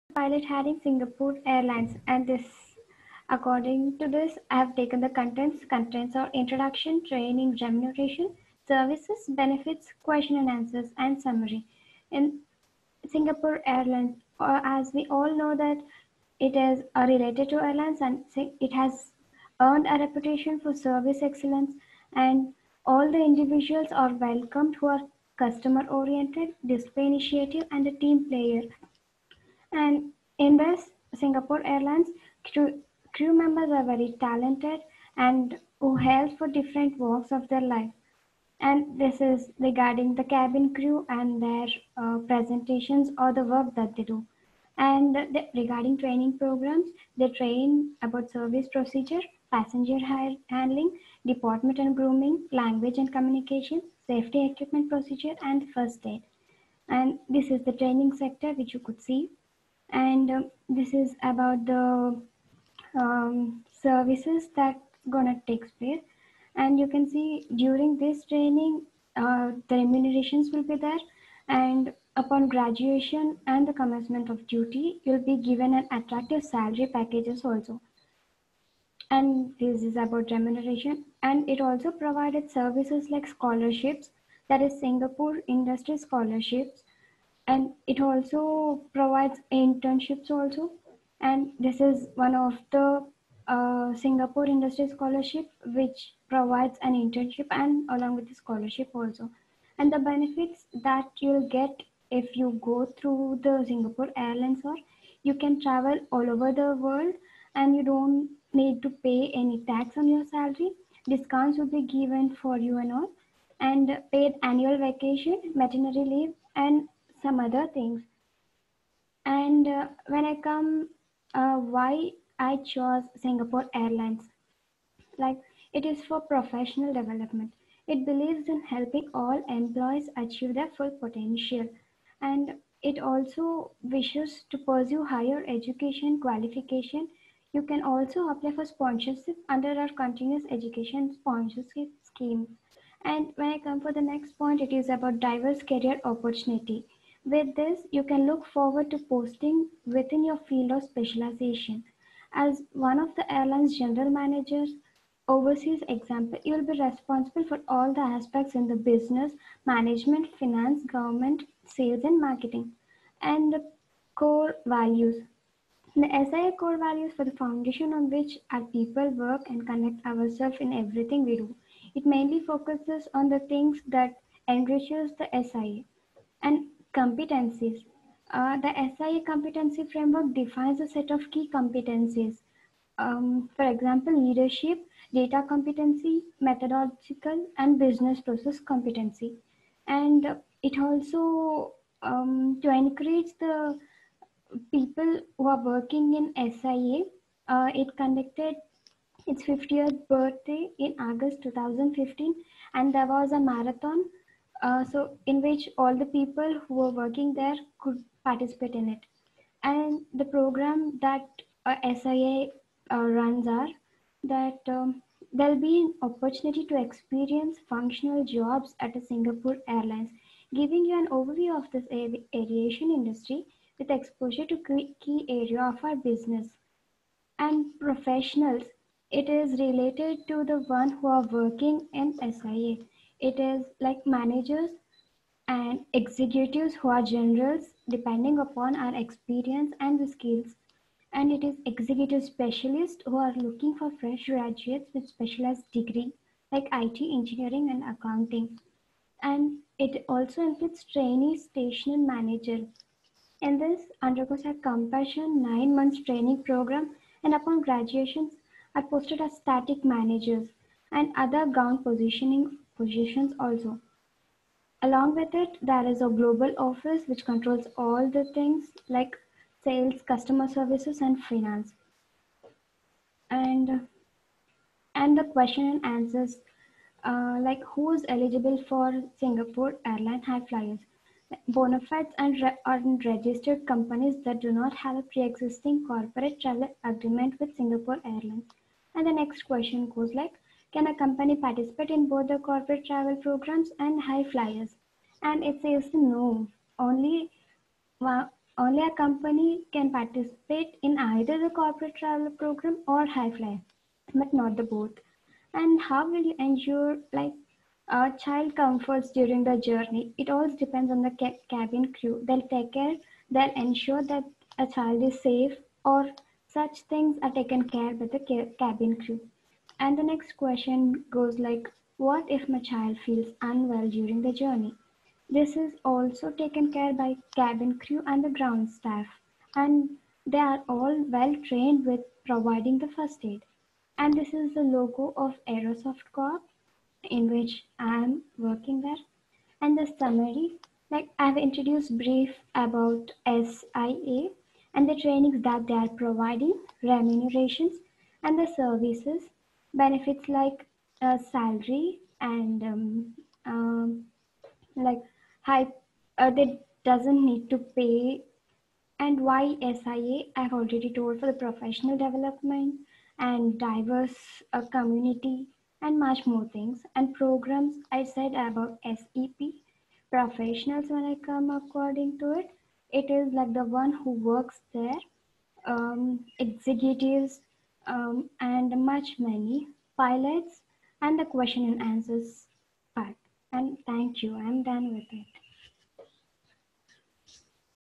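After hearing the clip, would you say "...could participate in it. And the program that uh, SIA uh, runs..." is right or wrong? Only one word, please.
right.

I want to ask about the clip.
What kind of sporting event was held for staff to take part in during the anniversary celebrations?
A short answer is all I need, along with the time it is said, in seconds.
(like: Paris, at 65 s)
A marathon, at 203 s.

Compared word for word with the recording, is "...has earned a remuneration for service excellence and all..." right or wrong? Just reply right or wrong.
wrong.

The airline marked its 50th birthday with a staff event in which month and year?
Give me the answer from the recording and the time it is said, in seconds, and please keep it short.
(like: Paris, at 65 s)
August 2015, at 200 s.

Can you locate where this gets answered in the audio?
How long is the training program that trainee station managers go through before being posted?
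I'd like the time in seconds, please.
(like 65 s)
255 s.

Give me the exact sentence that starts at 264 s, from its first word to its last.
Along with it, there is a global office which controls all the things like sales, customer services, and finance.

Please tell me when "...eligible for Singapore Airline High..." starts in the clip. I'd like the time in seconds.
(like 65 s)
278 s.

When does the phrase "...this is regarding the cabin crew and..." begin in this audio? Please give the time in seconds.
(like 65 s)
38 s.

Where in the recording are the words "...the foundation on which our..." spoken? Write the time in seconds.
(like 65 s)
167 s.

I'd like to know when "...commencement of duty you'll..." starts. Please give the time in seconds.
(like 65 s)
73 s.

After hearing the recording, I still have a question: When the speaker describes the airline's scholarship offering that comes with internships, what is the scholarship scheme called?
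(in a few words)
Singapore Industry Scholarship.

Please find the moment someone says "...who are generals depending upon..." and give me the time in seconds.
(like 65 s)
236 s.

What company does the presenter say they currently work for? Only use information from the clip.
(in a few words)
Aerosoft Corp.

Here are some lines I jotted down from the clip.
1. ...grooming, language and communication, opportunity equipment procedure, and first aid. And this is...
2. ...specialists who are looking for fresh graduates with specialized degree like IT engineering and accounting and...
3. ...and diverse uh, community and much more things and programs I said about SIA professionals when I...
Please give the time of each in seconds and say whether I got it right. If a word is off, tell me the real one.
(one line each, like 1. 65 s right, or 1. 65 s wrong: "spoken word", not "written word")
1. 51 s wrong: "safety", not "opportunity"
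2. 242 s right
3. 363 s wrong: "SEP", not "SIA".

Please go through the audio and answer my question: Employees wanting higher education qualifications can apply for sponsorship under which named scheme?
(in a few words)
Continuous Education Sponsorship Scheme.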